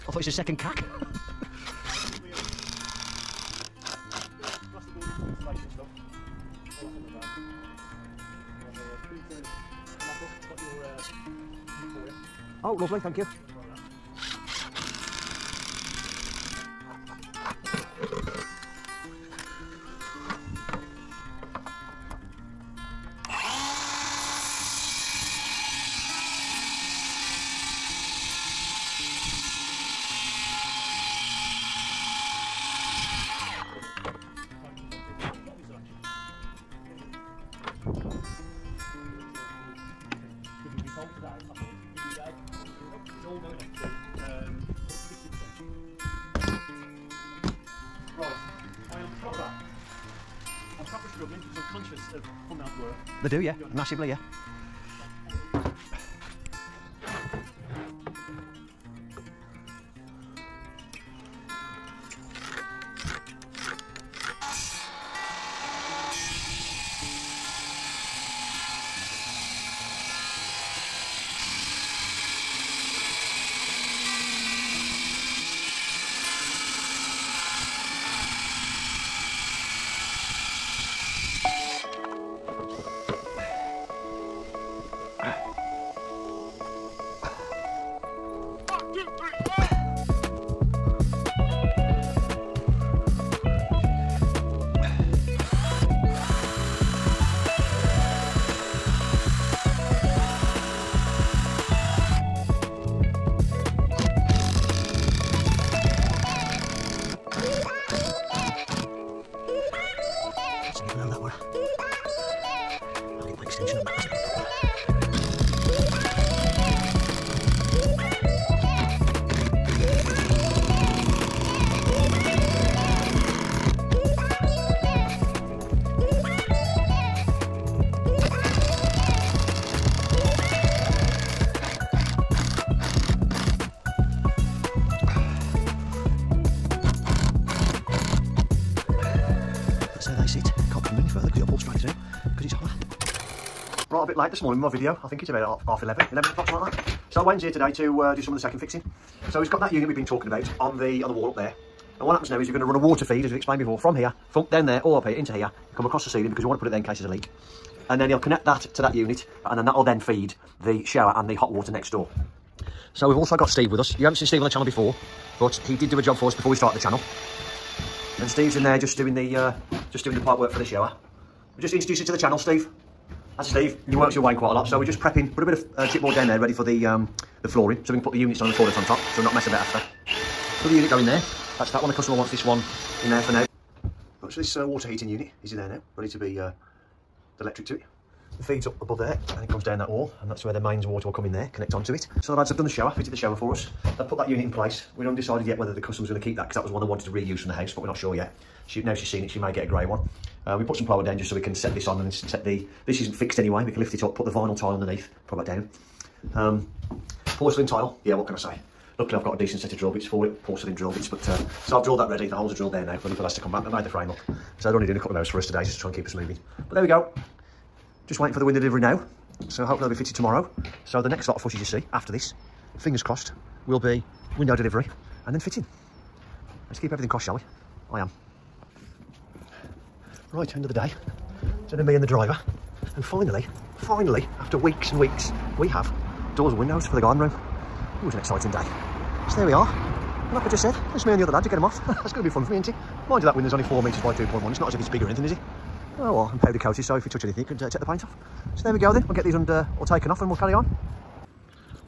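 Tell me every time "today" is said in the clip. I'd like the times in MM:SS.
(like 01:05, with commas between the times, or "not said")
02:27, 03:35.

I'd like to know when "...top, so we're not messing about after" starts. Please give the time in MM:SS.
02:58.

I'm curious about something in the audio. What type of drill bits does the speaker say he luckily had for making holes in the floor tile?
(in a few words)
Porcelain drill bits.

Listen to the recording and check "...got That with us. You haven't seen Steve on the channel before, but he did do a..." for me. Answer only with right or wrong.
wrong.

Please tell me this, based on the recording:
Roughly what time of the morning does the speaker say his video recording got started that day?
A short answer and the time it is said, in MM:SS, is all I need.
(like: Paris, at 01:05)
11 o'clock, at 02:26.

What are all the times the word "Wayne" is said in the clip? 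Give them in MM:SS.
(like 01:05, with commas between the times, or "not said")
02:27, 02:54.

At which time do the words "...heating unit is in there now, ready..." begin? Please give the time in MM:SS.
03:04.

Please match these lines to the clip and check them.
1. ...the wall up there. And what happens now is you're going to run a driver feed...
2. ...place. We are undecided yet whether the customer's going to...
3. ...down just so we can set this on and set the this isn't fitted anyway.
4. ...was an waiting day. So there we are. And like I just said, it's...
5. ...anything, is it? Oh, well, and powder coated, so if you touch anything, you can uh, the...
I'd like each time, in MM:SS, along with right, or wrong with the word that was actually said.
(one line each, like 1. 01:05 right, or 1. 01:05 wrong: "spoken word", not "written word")
1. 02:31 wrong: "water", not "driver"
2. 03:14 right
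3. 03:21 wrong: "fixed", not "fitted"
4. 03:58 wrong: "exciting", not "waiting"
5. 04:05 right.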